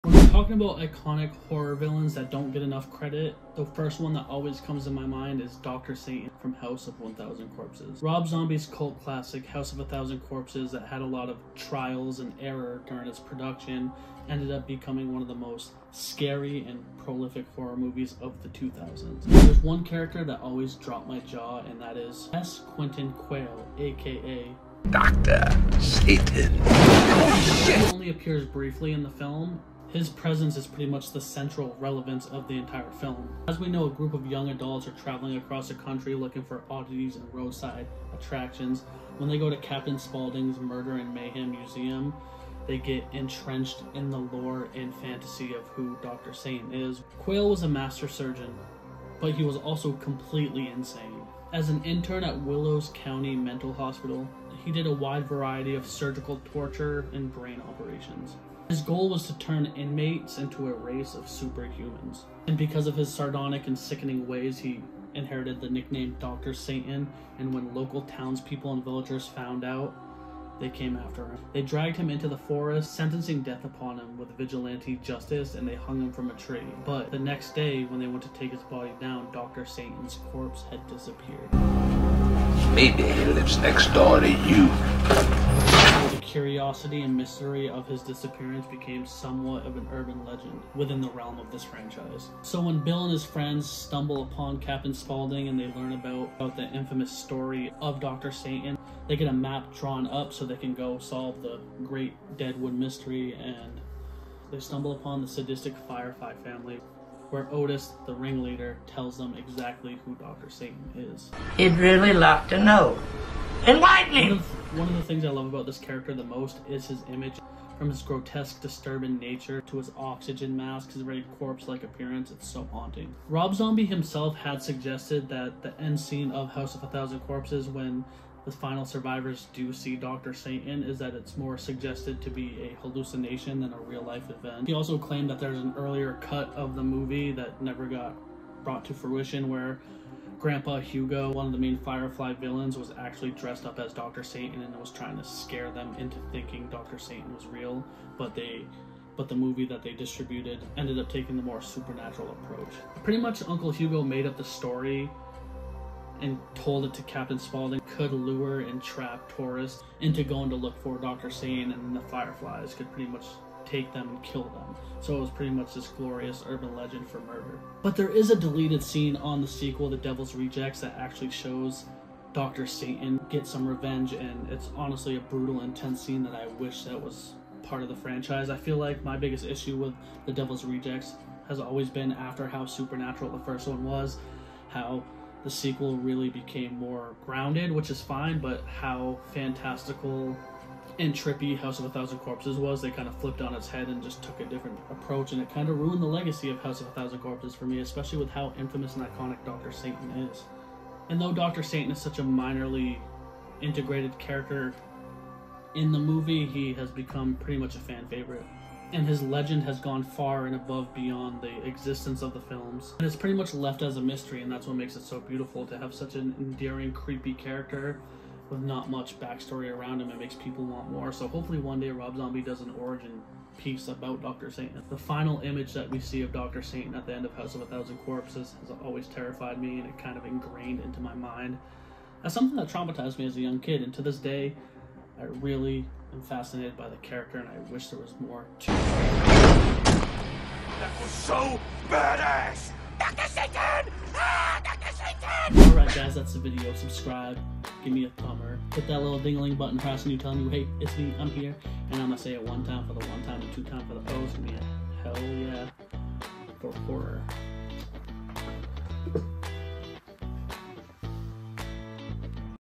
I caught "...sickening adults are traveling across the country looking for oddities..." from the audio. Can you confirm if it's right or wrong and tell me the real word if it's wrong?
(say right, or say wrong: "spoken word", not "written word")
wrong: "young", not "sickening".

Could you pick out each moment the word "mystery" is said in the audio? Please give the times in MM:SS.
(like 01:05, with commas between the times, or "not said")
01:27, 01:42, 03:34.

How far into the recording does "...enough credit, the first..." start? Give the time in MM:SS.
00:02.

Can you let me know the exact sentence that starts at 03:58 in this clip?
That was so badass, Doctor Satan!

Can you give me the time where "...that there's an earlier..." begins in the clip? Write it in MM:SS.
02:15.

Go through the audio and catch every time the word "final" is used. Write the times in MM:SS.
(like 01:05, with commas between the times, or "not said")
02:08, 03:44.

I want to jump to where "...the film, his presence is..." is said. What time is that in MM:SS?
00:29.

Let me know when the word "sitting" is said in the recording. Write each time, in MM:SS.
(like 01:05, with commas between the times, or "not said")
not said.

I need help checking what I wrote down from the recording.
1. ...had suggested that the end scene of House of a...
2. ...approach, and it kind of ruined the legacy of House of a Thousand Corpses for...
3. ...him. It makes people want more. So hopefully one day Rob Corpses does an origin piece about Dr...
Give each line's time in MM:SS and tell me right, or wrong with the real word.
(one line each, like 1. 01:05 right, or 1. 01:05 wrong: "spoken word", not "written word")
1. 02:04 right
2. 03:14 right
3. 03:40 wrong: "Zombie", not "Corpses".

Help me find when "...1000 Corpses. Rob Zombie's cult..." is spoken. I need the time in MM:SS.
00:06.